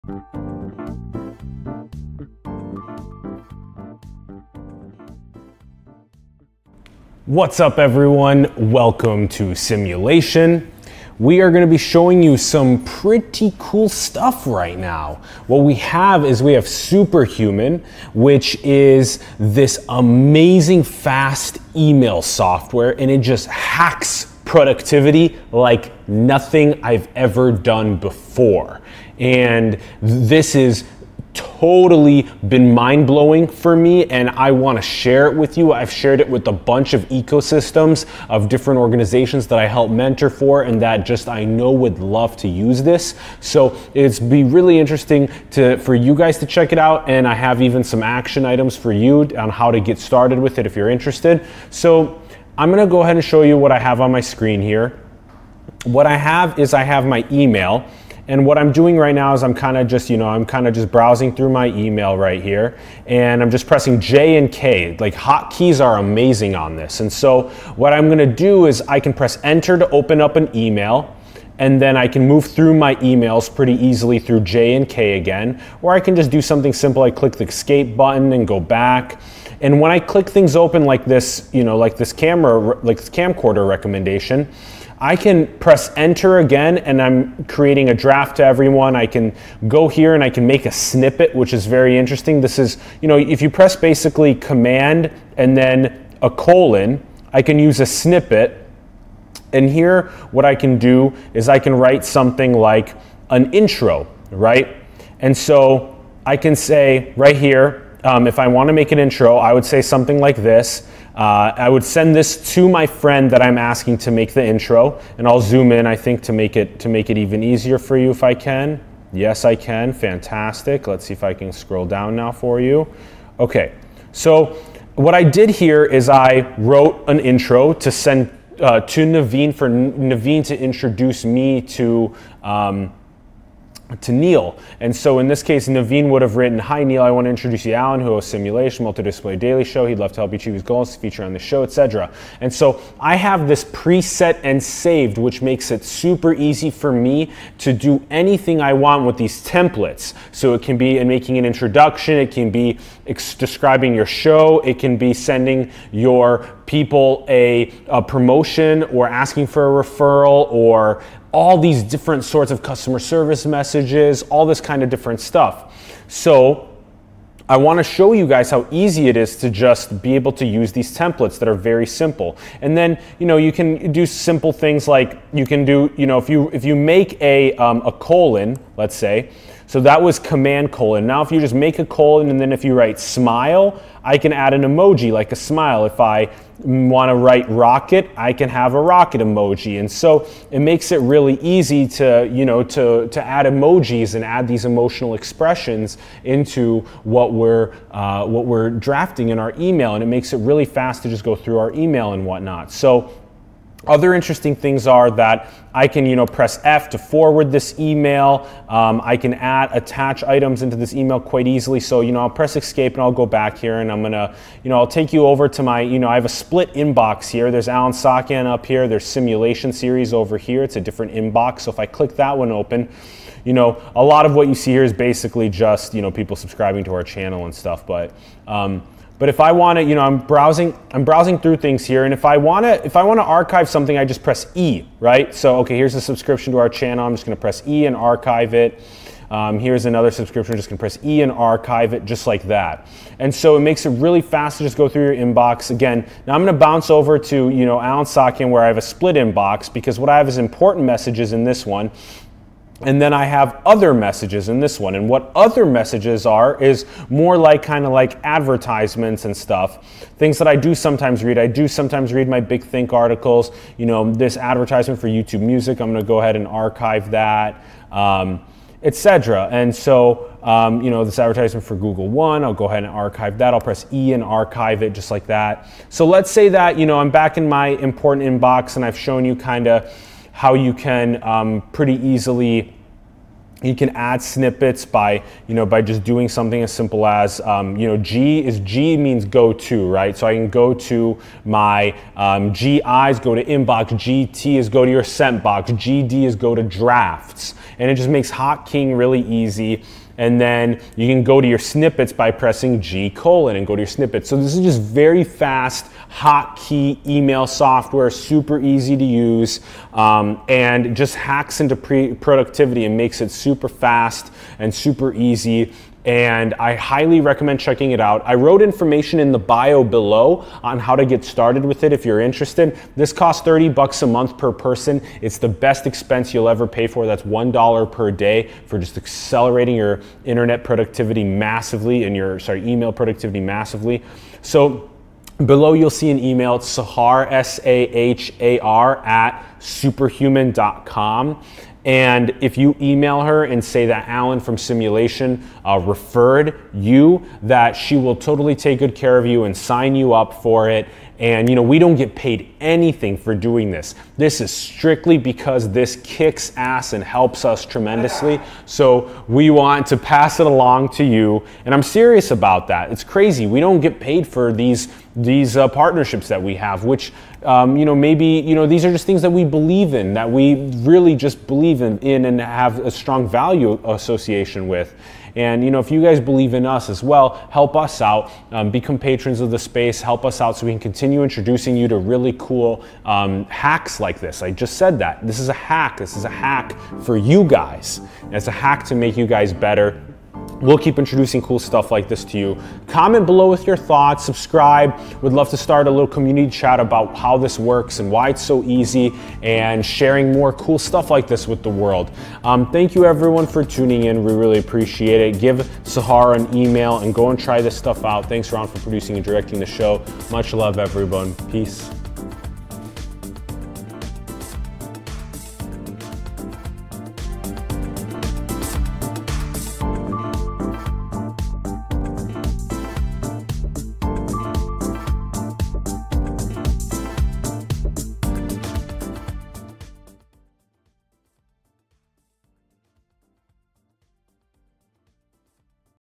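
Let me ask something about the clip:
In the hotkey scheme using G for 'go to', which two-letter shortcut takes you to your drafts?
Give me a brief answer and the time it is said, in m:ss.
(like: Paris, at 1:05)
GD, at 4:55.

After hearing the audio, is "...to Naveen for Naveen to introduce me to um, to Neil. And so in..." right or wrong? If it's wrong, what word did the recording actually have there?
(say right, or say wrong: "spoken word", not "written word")
right.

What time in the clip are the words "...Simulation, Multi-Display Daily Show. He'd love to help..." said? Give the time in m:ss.
2:18.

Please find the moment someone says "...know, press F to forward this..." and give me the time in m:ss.
3:26.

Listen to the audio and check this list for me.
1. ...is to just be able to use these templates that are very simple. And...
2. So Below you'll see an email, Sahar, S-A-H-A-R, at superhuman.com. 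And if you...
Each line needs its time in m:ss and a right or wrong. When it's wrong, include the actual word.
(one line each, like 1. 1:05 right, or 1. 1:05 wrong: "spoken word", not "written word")
1. 2:49 right
2. 5:34 right.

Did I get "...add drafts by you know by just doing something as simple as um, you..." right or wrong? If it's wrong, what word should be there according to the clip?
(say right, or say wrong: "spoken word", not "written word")
wrong: "snippets", not "drafts".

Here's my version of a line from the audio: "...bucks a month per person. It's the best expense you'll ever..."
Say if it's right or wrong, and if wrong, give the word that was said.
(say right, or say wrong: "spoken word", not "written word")
right.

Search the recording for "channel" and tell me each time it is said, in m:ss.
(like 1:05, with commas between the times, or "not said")
3:47, 3:56.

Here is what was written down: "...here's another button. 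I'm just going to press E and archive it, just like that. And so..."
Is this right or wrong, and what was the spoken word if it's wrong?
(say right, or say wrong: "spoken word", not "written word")
wrong: "subscription", not "button".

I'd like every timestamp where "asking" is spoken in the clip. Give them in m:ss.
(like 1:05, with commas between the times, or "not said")
1:53, 2:39.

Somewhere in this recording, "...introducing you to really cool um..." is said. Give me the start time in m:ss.
6:21.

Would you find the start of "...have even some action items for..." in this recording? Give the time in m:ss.
0:47.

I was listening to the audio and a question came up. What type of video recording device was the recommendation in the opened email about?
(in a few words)
camcorder.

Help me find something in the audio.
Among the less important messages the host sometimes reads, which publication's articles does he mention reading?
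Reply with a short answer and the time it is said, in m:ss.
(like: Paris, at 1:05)
Big Think, at 4:22.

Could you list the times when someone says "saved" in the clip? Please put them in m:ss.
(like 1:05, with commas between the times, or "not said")
2:24.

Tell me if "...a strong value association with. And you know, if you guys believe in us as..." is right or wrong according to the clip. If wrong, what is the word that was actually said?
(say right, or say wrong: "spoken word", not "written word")
right.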